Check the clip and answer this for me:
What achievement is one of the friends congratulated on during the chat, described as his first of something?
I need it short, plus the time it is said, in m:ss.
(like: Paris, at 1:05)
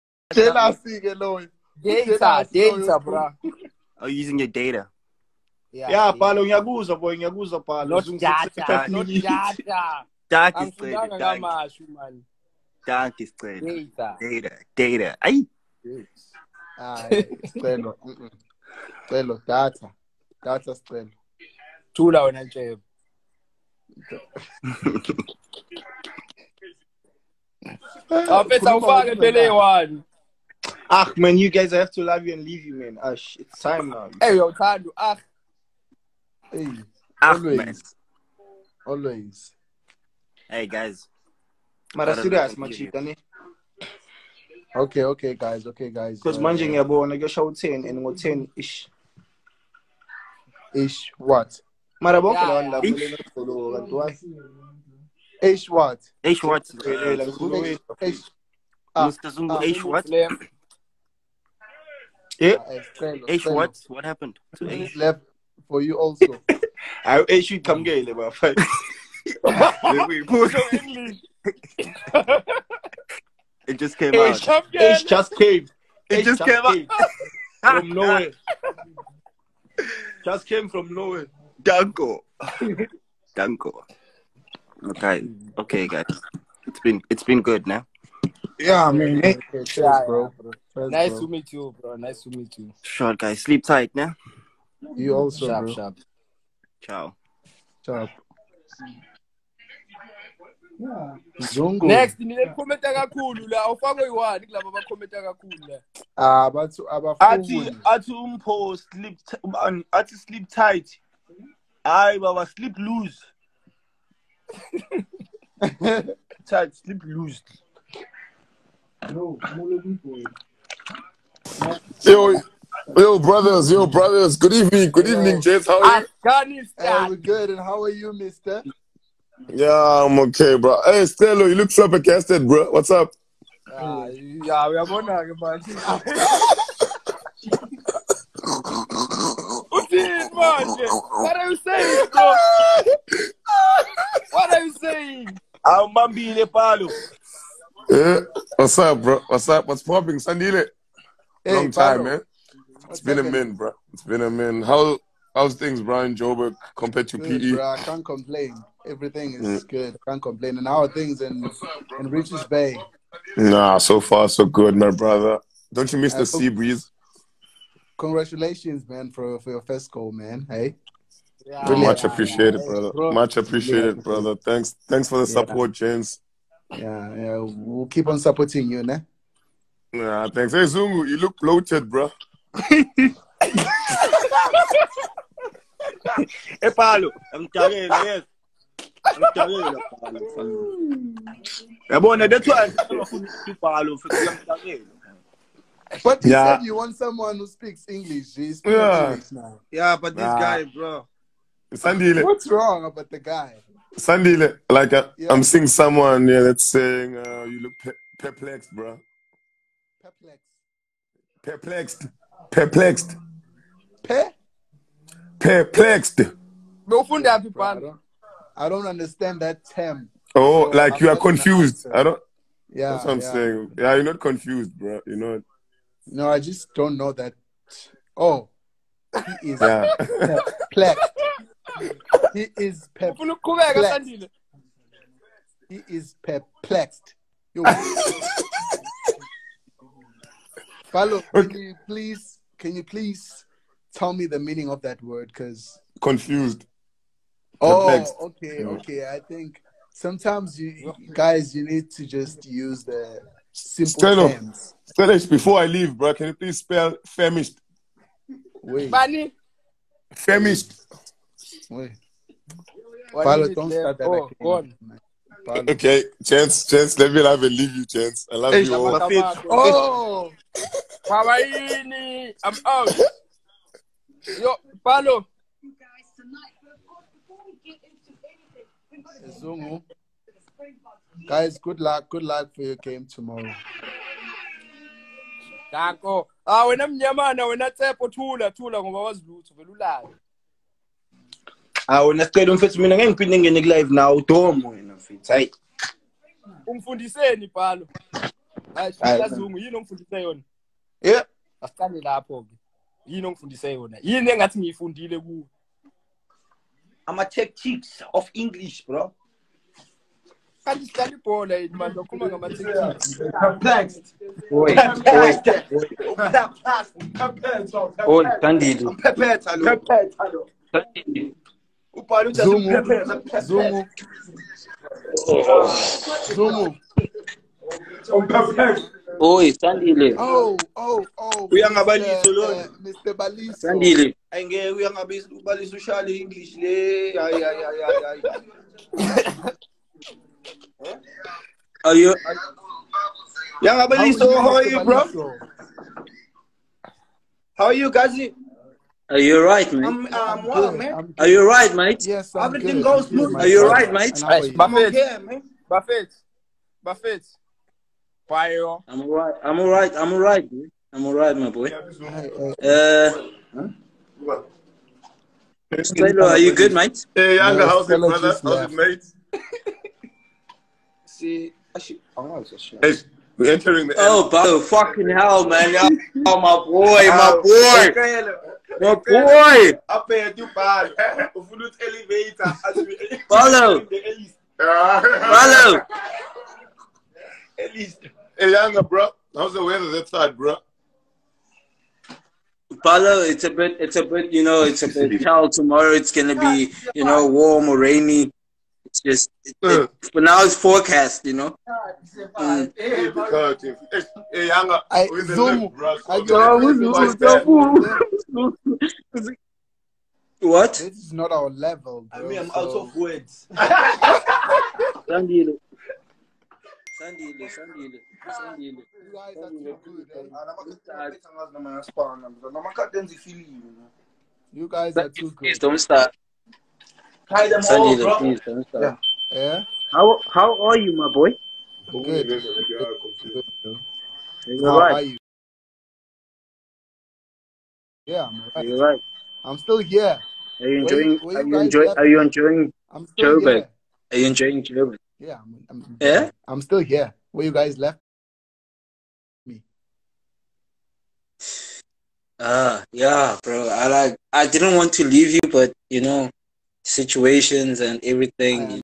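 first goal, at 2:49.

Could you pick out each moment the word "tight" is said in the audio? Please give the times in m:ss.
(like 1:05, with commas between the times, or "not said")
1:33, 1:50, 1:56.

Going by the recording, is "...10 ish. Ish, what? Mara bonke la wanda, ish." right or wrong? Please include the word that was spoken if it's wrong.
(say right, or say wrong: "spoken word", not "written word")
right.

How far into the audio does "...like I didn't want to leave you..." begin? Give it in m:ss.
7:33.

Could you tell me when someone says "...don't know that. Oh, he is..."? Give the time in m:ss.
3:46.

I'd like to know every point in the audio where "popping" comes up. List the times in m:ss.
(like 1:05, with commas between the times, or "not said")
2:29.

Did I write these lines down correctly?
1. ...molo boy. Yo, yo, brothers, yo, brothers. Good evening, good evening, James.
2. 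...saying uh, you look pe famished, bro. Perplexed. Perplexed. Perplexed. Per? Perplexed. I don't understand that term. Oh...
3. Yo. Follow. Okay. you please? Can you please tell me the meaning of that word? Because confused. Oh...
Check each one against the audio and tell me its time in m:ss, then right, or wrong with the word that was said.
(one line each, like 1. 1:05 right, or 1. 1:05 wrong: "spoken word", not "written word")
1. 1:59 right
2. 3:26 wrong: "perplexed", not "famished"
3. 3:57 right.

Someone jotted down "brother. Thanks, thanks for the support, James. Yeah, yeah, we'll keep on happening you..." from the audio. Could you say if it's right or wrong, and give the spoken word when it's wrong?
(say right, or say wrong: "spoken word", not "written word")
wrong: "supporting", not "happening".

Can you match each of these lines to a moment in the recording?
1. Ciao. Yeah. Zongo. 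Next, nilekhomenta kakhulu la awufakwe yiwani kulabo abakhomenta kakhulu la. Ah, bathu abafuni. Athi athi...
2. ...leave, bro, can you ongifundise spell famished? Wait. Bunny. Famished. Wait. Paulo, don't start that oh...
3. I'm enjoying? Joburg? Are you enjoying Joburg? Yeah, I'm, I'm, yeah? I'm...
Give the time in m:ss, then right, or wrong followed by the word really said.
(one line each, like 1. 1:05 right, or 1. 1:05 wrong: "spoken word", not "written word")
1. 1:37 right
2. 4:15 wrong: "please", not "ongifundise"
3. 7:22 right.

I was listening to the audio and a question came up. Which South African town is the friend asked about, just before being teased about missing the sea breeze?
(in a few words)
Richards Bay.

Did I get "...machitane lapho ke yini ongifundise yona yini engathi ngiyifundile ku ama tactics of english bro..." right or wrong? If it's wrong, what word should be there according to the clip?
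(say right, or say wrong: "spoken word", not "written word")
wrong: "asicane", not "machitane".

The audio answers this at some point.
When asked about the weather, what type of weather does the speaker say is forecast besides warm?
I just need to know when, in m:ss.
6:37.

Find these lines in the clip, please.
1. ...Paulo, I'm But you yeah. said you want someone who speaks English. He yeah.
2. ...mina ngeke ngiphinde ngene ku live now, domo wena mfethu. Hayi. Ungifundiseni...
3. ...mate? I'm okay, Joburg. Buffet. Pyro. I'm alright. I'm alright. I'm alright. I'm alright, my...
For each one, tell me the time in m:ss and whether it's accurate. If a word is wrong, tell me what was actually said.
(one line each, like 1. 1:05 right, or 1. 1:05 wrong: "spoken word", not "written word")
1. 3:13 right
2. 4:52 right
3. 5:53 wrong: "Buffet", not "Joburg".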